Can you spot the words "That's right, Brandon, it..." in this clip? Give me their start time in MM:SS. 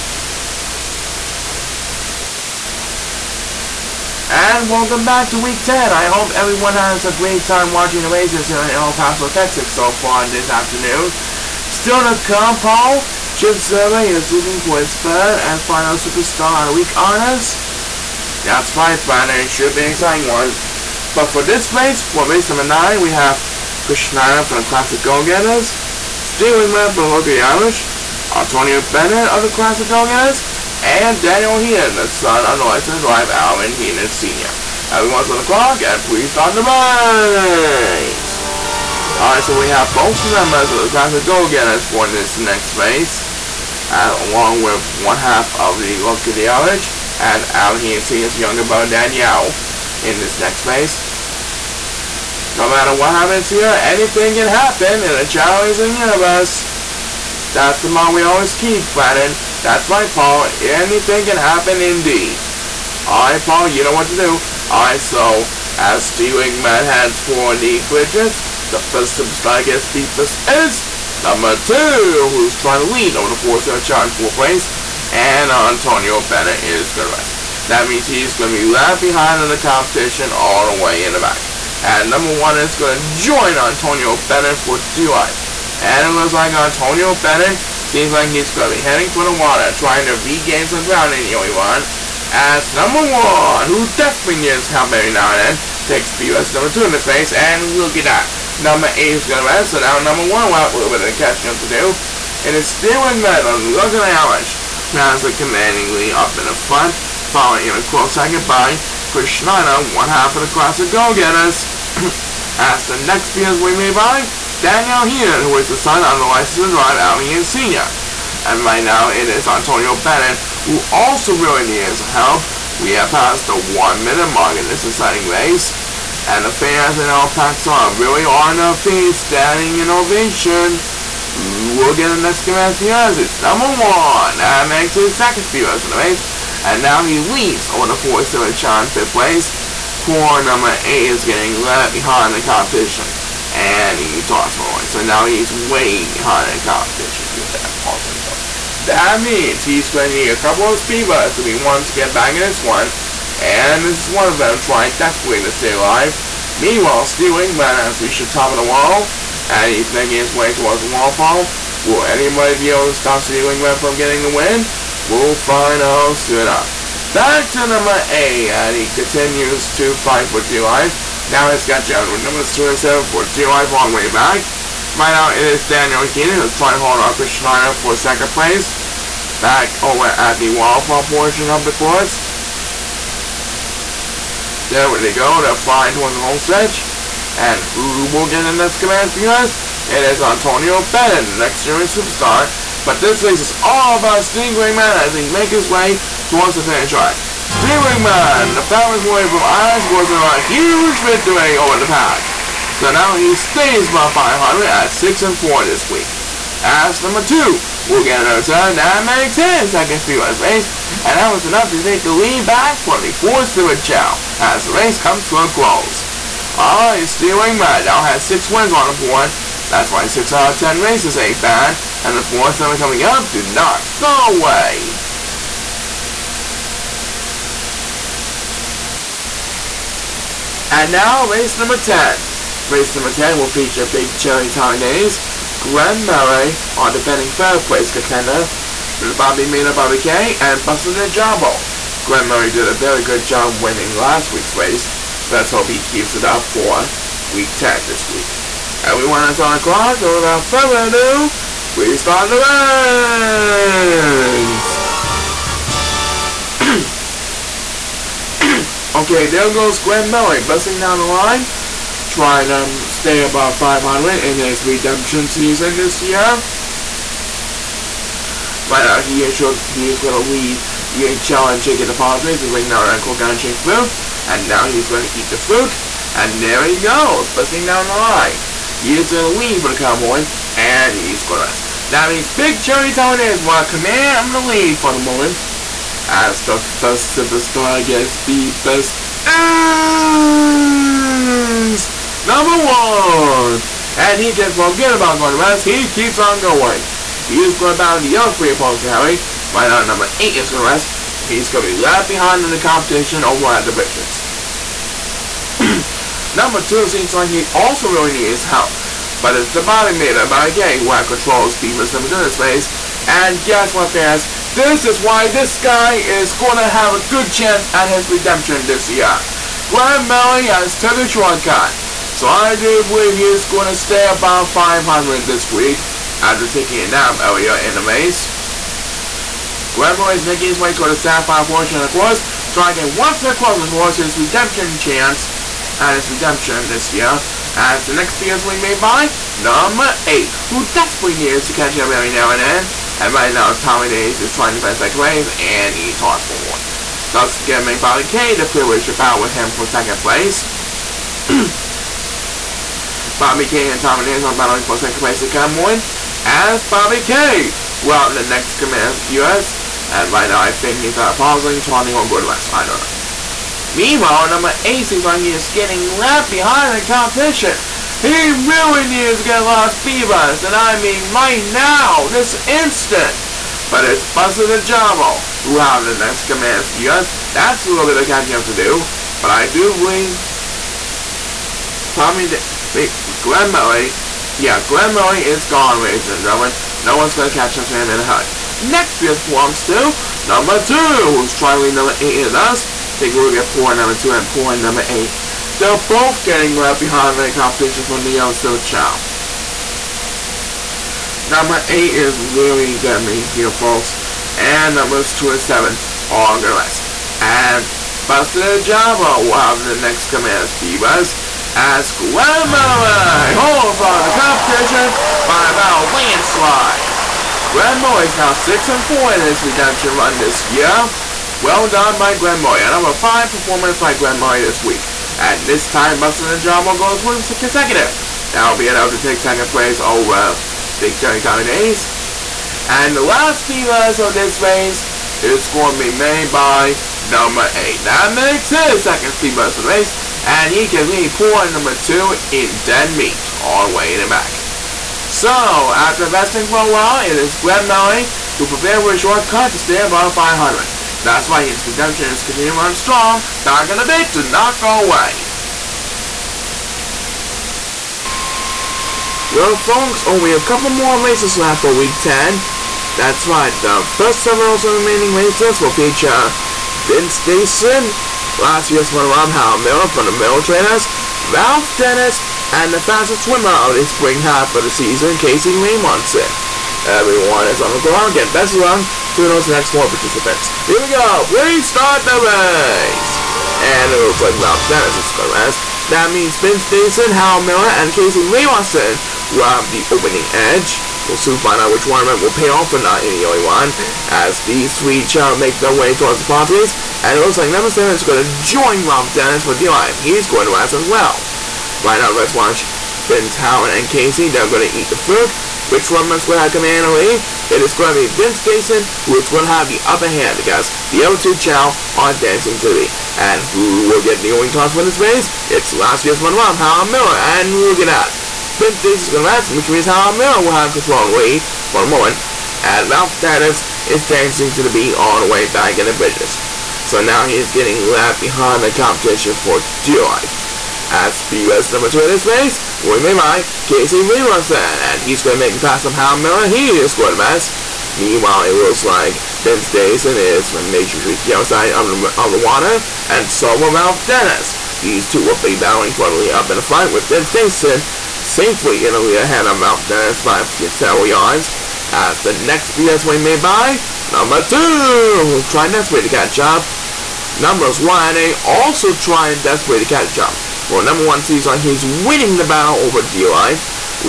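00:18.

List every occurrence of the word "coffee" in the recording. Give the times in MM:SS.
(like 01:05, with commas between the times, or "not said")
not said.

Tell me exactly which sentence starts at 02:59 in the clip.
Back over at the waterfall portion of the course.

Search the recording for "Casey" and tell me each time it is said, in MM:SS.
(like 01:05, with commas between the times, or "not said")
07:55, 08:07, 08:23, 08:53.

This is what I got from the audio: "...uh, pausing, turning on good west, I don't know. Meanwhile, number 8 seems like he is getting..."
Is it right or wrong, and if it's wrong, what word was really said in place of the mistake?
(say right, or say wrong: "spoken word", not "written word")
right.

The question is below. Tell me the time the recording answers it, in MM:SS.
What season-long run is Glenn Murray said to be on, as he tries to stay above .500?
04:24.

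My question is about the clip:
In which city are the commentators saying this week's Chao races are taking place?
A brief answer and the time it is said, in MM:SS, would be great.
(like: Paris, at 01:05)
El Paso, Texas, at 00:08.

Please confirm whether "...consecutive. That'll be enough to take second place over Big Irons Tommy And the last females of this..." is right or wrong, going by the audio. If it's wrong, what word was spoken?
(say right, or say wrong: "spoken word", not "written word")
wrong: "Johnny", not "Irons".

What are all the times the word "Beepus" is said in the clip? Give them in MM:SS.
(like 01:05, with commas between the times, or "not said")
01:09.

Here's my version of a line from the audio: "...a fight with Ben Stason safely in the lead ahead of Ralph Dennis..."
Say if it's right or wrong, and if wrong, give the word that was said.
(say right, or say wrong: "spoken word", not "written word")
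right.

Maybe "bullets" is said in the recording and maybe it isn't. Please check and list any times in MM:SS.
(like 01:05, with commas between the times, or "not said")
02:31.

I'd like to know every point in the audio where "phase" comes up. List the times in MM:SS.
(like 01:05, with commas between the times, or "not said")
00:42, 00:50.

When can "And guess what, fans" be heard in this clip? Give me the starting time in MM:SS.
05:13.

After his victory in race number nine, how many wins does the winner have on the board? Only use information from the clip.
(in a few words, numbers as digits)
6.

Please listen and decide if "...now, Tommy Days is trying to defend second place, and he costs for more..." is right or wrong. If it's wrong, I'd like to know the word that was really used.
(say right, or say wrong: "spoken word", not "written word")
right.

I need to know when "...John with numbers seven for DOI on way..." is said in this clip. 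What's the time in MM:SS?
02:51.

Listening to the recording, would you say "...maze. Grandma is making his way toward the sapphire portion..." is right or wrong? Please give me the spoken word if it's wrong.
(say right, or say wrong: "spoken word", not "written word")
right.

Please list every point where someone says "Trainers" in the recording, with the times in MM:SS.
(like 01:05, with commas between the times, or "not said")
07:50.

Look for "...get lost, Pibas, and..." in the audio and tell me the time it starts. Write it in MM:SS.
06:09.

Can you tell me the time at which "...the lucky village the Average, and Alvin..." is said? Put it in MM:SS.
00:45.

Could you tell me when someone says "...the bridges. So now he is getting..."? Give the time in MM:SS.
08:45.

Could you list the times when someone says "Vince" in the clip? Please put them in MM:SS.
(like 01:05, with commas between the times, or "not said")
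07:46, 08:28, 08:38.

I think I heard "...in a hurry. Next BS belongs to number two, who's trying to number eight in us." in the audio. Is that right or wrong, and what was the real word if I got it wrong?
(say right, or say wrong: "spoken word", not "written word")
right.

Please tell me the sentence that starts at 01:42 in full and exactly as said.
And it's still in medal, look at how much.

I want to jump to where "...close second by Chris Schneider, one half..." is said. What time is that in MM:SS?
01:47.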